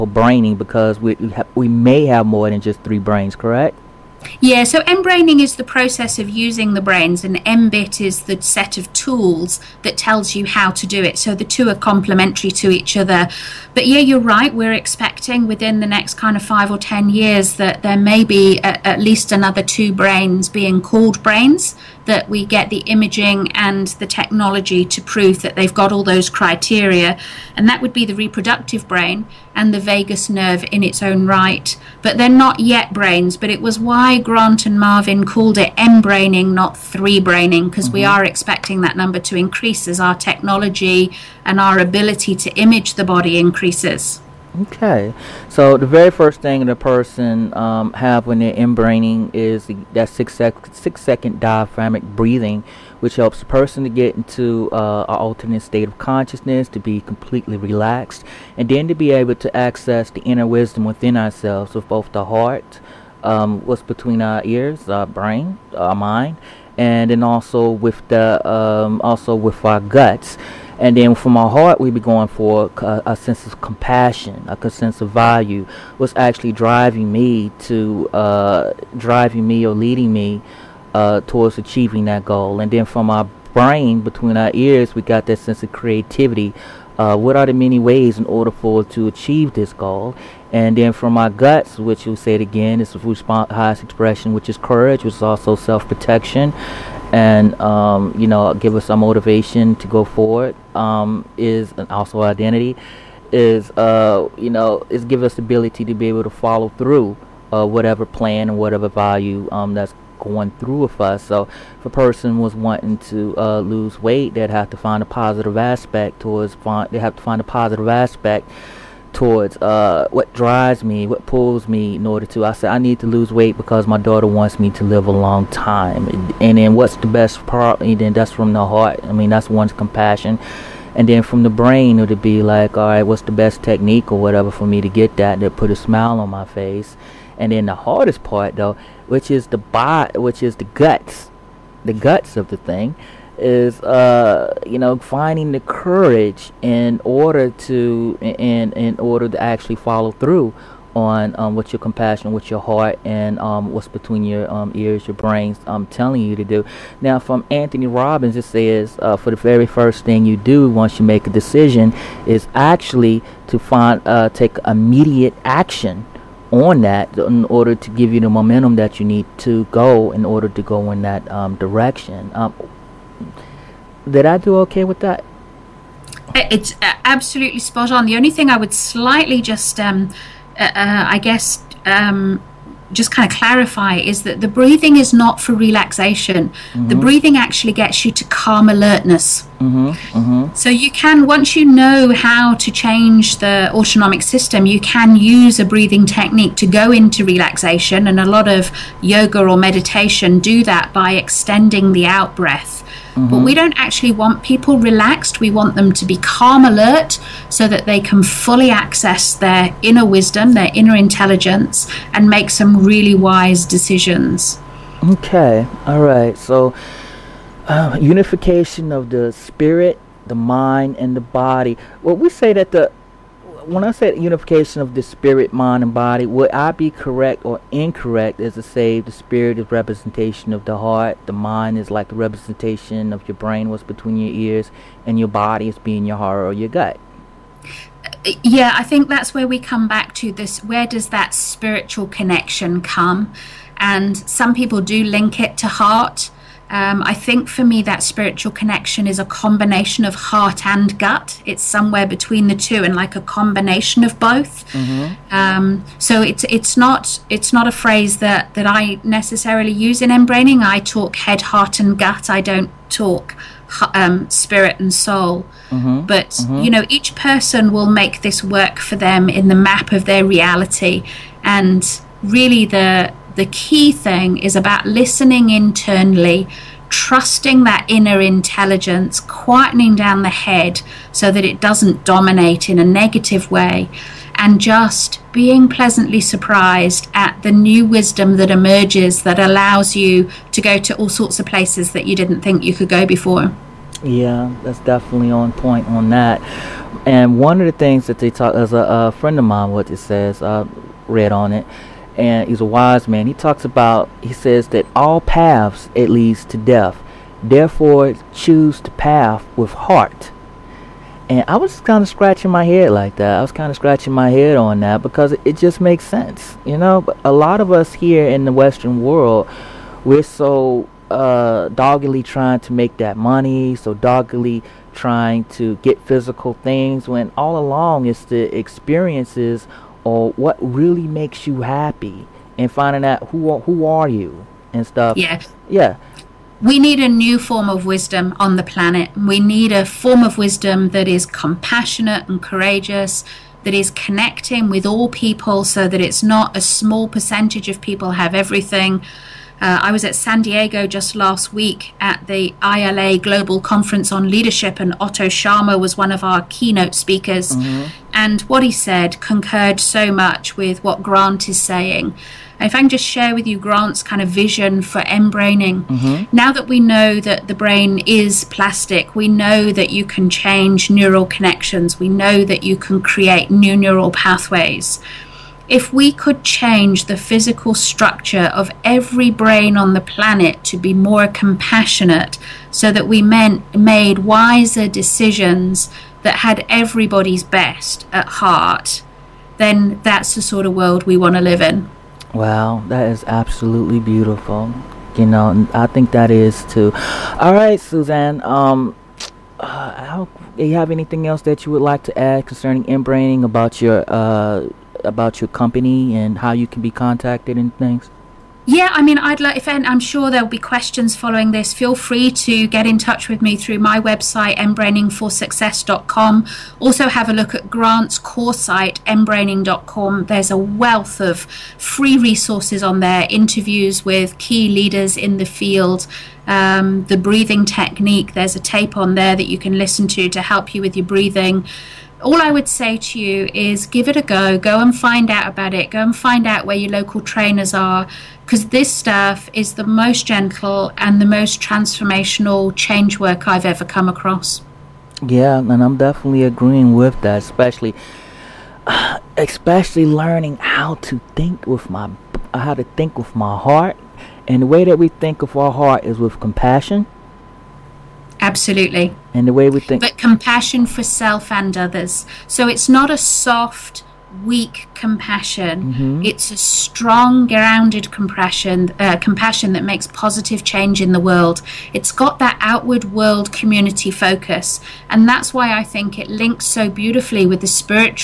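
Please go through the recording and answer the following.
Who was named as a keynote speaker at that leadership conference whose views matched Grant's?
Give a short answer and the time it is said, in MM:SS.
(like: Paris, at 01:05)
Otto Scharmer, at 05:55.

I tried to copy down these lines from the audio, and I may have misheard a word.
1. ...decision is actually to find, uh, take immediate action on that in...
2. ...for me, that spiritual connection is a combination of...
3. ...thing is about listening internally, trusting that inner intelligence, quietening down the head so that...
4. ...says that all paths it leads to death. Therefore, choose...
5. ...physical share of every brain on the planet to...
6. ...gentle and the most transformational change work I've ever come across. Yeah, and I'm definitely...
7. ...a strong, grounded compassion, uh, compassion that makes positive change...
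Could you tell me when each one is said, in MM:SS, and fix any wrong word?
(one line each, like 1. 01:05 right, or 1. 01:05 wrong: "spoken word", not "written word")
1. 02:41 right
2. 04:07 right
3. 04:33 right
4. 05:04 right
5. 06:17 wrong: "structure", not "share"
6. 07:20 right
7. 07:46 right.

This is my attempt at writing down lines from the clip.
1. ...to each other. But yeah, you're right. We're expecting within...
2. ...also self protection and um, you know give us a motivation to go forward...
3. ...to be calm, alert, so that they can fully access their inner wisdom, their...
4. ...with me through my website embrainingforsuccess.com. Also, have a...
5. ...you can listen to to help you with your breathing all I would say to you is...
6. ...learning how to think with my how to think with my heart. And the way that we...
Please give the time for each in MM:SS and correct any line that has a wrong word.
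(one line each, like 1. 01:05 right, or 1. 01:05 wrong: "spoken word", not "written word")
1. 00:12 right
2. 01:35 right
3. 03:25 right
4. 06:53 right
5. 07:09 right
6. 07:30 right.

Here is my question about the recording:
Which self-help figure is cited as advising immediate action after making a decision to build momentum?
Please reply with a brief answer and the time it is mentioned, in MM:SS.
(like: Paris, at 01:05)
Anthony Robbins, at 02:37.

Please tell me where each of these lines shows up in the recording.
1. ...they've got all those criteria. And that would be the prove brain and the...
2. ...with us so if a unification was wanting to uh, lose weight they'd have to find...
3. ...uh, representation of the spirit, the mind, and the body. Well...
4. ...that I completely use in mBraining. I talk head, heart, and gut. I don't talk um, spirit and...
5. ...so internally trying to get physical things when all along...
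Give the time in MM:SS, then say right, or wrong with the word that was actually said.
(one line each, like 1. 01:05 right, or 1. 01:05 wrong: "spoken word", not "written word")
1. 00:25 wrong: "reproductive", not "prove"
2. 01:50 wrong: "person", not "unification"
3. 03:37 wrong: "unification", not "representation"
4. 04:18 wrong: "necessarily", not "completely"
5. 05:23 wrong: "doggedly", not "internally".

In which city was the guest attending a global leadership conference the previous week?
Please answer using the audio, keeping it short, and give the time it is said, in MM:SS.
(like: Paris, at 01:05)
San Diego, at 05:50.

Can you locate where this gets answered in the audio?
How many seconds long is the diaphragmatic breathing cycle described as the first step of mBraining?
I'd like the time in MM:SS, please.
00:50.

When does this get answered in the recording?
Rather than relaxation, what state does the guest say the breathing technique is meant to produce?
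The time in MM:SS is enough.
03:08.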